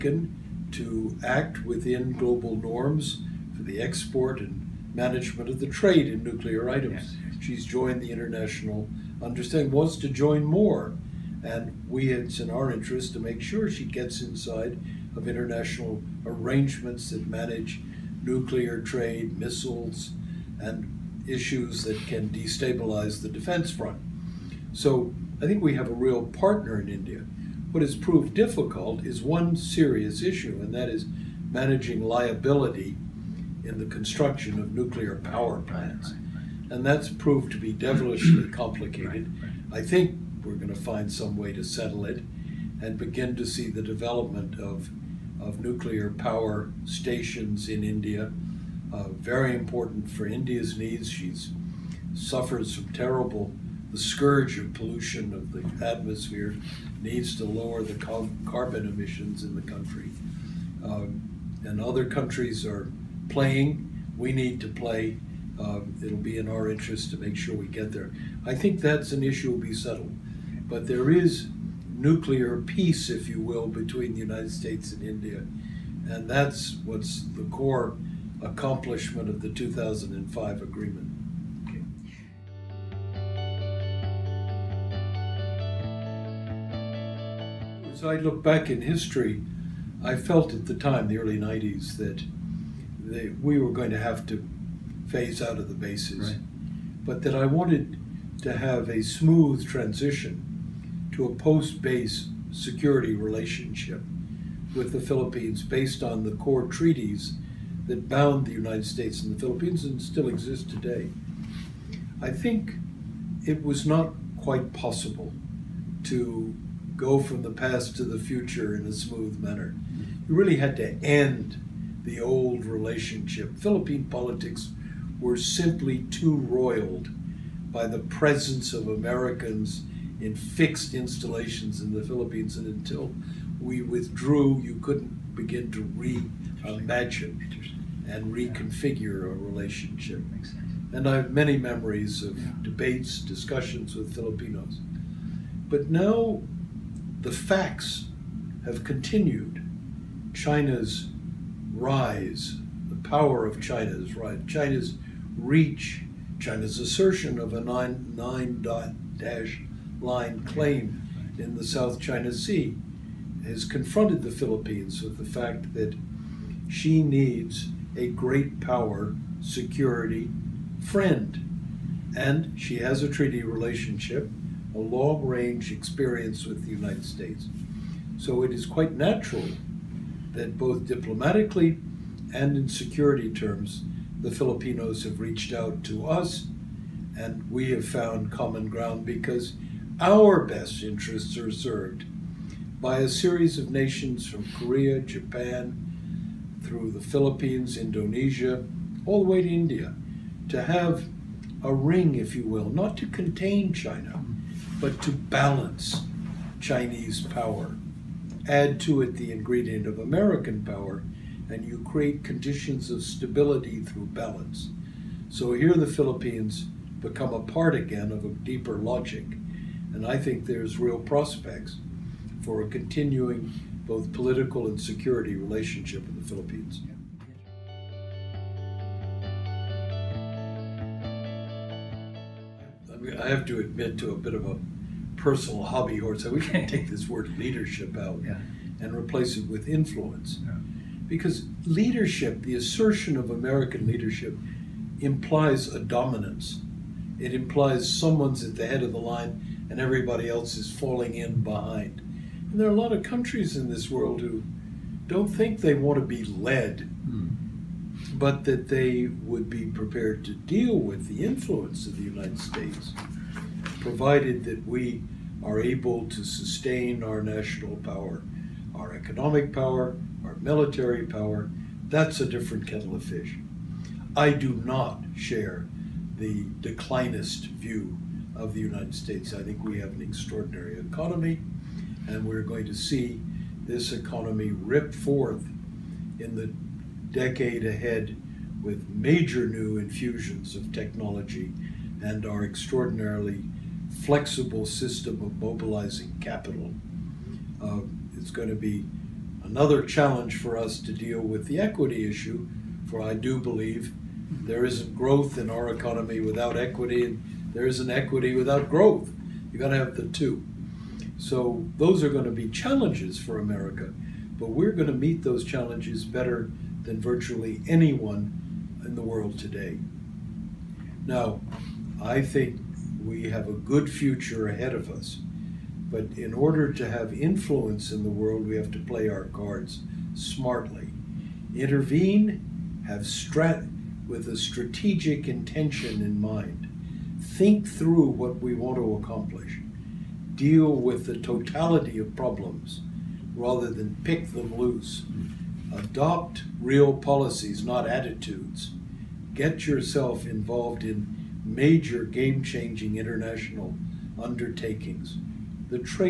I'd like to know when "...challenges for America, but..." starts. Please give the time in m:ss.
5:12.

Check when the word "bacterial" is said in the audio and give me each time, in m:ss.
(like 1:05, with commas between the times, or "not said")
not said.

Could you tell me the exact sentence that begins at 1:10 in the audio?
But there is nuclear peace, if you will, between the United States and India.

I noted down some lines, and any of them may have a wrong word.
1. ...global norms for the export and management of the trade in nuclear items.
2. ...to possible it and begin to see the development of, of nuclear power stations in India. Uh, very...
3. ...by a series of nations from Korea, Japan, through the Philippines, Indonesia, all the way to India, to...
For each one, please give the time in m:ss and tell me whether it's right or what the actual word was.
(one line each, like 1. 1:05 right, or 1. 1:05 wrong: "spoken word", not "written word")
1. 0:02 right
2. 0:41 wrong: "settle", not "possible"
3. 3:12 right.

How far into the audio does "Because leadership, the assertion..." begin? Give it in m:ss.
4:01.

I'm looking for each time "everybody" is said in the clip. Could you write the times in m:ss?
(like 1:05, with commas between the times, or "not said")
4:09.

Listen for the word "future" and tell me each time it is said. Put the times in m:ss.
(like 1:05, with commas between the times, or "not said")
1:58, 5:23.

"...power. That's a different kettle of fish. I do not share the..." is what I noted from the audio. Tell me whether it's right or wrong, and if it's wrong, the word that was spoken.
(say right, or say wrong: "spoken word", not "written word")
right.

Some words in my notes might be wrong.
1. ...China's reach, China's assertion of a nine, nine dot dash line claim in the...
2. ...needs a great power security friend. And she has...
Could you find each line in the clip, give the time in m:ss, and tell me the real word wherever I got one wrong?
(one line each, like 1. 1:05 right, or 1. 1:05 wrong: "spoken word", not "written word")
1. 2:34 right
2. 2:47 right.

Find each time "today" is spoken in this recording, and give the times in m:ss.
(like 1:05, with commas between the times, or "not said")
1:50, 5:19.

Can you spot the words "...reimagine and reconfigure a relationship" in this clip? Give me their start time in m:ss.
2:15.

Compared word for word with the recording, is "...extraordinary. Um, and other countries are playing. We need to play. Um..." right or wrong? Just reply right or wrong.
wrong.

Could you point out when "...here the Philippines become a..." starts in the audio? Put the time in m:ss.
3:35.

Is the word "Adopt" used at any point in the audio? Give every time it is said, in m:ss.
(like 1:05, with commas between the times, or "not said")
5:45.